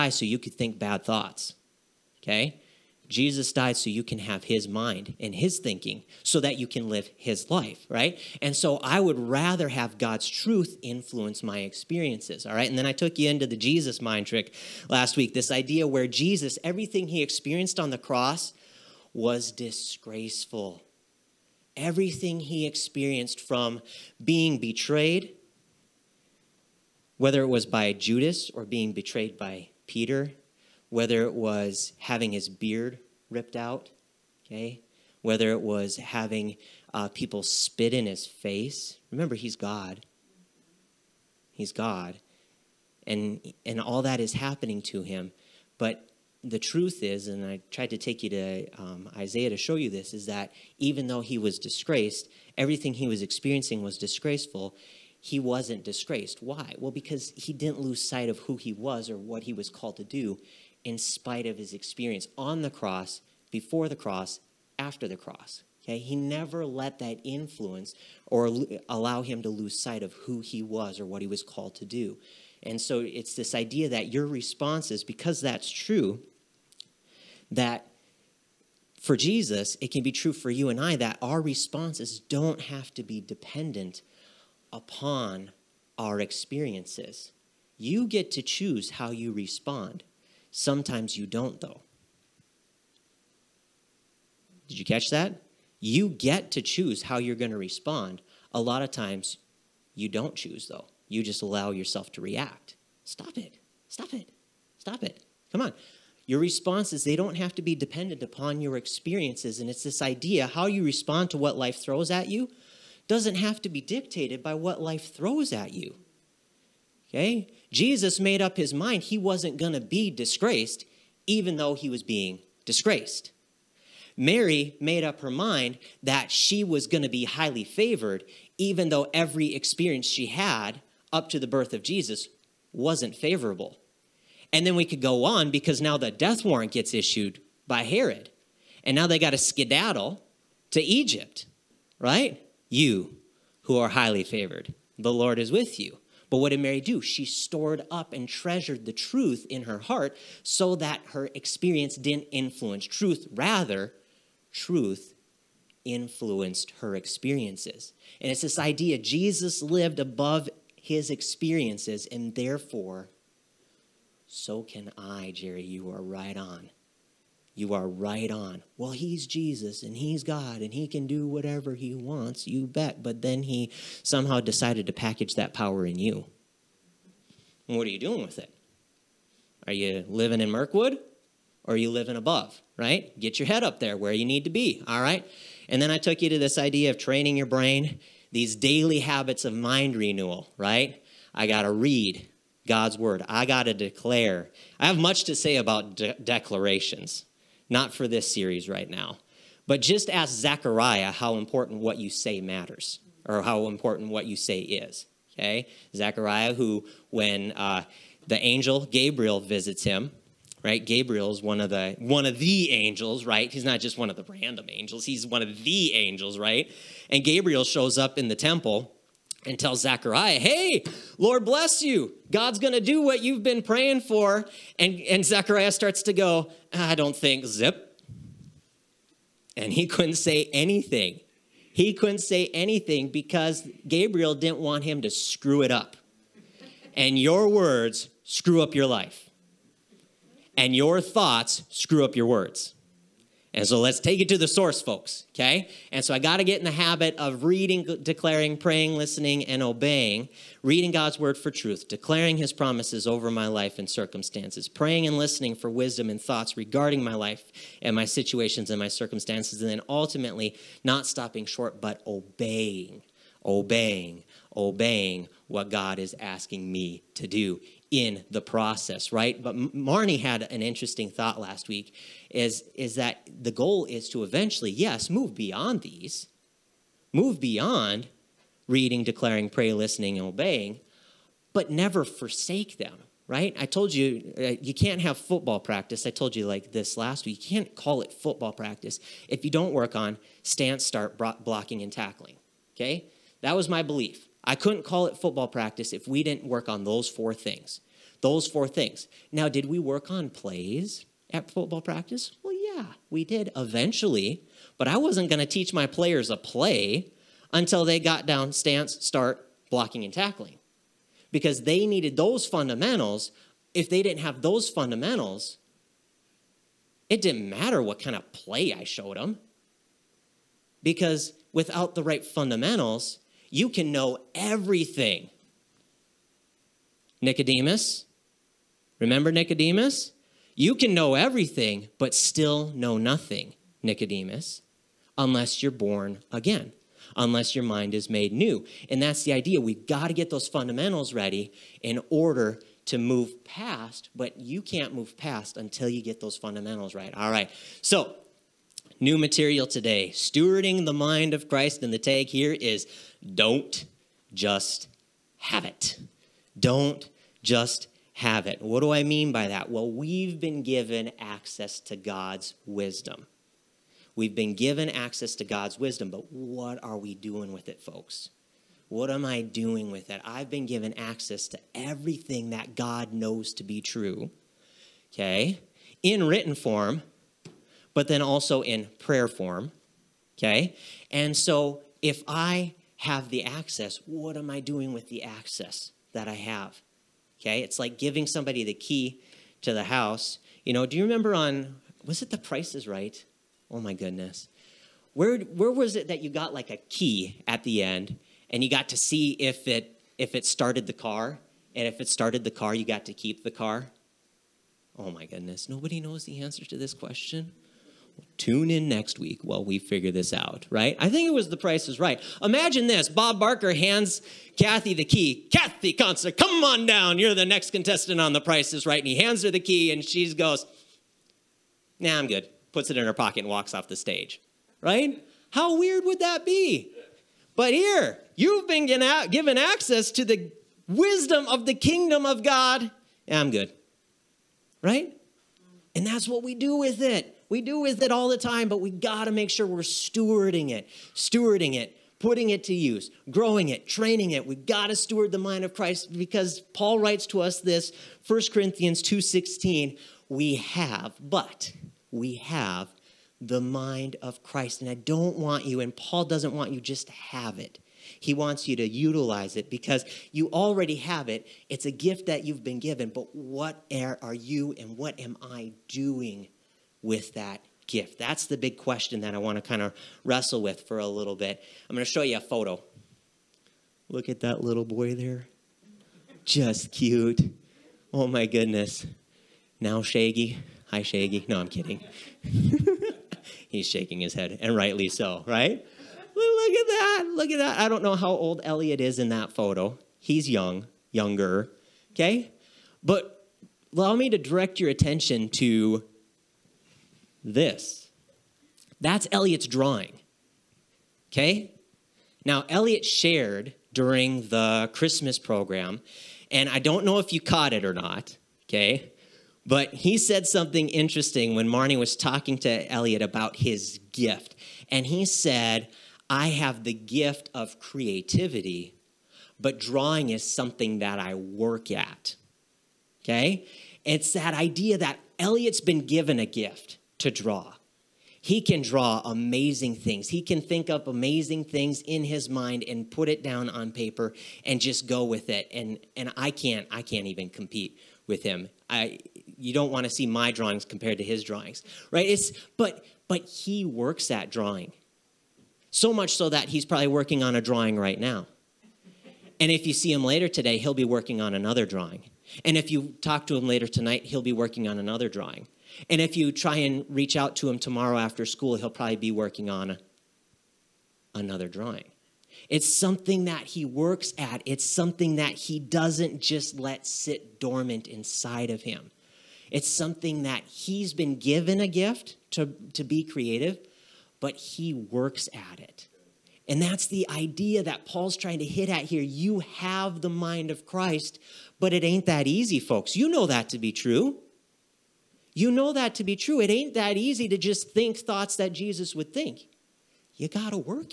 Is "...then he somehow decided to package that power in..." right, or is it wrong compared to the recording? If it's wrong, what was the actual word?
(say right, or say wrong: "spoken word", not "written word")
right.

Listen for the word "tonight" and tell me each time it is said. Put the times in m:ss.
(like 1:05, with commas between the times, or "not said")
9:13.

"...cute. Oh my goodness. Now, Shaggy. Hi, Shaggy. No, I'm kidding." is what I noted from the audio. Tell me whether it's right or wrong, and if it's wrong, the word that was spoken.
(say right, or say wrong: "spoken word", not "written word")
right.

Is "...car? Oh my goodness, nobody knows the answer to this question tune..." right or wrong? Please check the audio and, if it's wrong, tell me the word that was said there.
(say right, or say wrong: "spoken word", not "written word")
right.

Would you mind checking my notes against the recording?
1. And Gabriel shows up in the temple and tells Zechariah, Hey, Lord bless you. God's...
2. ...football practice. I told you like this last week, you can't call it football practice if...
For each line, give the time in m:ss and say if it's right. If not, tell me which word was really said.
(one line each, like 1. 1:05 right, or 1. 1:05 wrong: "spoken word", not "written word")
1. 3:37 right
2. 4:45 right.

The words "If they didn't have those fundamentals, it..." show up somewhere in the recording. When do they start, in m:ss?
5:13.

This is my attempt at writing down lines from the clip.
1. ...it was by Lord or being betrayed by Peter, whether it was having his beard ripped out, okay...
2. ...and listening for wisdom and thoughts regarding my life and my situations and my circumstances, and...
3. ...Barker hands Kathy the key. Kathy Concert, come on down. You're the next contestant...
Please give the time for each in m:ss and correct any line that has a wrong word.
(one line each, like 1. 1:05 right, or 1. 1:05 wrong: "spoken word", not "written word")
1. 0:27 wrong: "Judas", not "Lord"
2. 4:15 right
3. 6:53 right.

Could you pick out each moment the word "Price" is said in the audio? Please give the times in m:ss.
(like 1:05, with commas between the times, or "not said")
6:32, 6:51, 6:58.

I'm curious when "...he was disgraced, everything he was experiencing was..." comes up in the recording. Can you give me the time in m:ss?
0:51.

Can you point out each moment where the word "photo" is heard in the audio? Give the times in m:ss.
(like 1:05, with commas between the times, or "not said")
7:52, 8:09.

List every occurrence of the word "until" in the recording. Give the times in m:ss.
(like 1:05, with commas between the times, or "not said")
5:07, 5:45.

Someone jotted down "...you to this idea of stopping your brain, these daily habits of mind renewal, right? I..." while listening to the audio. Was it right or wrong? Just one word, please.
wrong.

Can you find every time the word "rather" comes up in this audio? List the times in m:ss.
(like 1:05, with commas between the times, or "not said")
0:09, 2:33.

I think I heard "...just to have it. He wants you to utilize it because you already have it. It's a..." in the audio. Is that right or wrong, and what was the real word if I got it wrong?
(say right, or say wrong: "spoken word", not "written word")
right.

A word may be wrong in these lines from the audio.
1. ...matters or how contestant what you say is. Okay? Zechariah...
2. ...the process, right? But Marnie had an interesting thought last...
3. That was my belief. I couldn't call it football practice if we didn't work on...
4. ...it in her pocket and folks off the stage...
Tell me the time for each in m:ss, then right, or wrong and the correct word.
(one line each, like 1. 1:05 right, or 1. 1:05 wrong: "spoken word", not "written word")
1. 3:22 wrong: "important", not "contestant"
2. 4:28 right
3. 4:53 right
4. 7:02 wrong: "walks", not "folks".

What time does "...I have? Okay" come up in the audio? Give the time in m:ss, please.
6:26.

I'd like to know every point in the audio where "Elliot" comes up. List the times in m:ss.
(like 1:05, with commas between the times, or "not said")
8:08.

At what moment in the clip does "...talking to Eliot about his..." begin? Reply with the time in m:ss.
8:32.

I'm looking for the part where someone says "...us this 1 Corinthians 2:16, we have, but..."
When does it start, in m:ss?
7:27.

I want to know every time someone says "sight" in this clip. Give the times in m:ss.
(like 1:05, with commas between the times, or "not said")
0:58, 1:09.